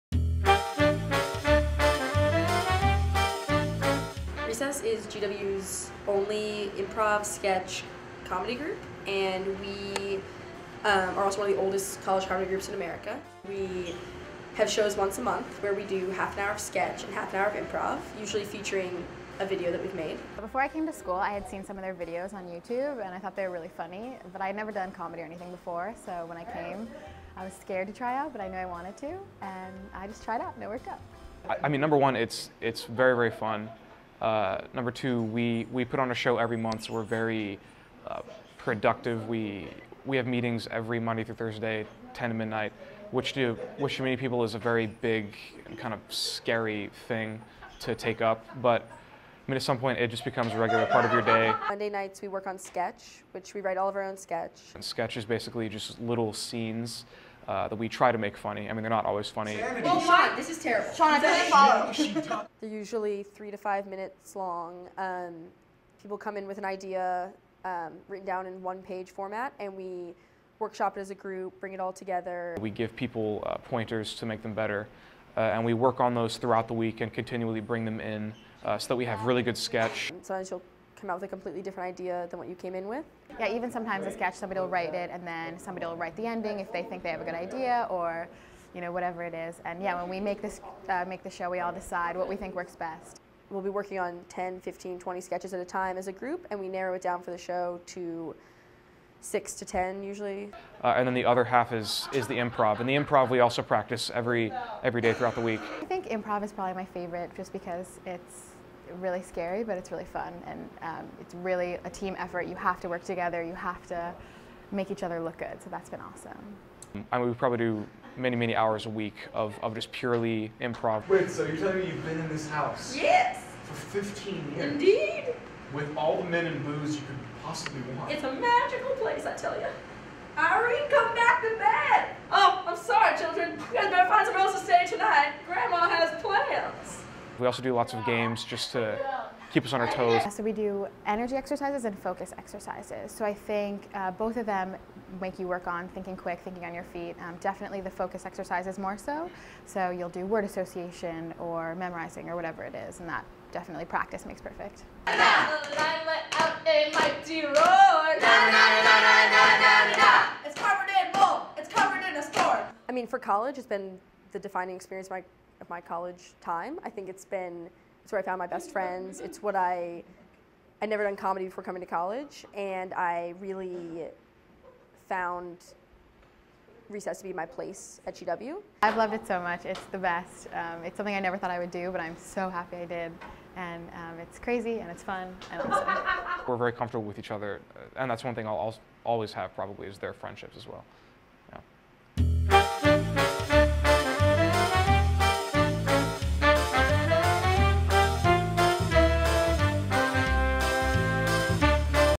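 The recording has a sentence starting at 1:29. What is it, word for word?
And yeah, when we make this, uh, make the show, we all decide what we think works best.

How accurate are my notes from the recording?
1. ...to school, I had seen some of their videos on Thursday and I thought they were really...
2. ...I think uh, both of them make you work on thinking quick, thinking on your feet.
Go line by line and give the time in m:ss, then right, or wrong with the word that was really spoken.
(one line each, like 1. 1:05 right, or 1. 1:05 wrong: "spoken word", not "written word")
1. 0:20 wrong: "YouTube", not "Thursday"
2. 2:23 right.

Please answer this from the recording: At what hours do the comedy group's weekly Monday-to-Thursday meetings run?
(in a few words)
10 to midnight.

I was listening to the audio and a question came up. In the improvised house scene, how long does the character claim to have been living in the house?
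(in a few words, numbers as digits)
15 years.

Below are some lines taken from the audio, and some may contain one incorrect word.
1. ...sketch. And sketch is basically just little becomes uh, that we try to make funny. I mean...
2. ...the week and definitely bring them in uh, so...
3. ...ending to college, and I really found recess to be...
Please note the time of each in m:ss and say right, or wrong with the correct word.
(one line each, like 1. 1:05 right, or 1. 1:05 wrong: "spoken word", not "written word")
1. 0:54 wrong: "scenes", not "becomes"
2. 1:16 wrong: "continually", not "definitely"
3. 2:51 wrong: "coming", not "ending".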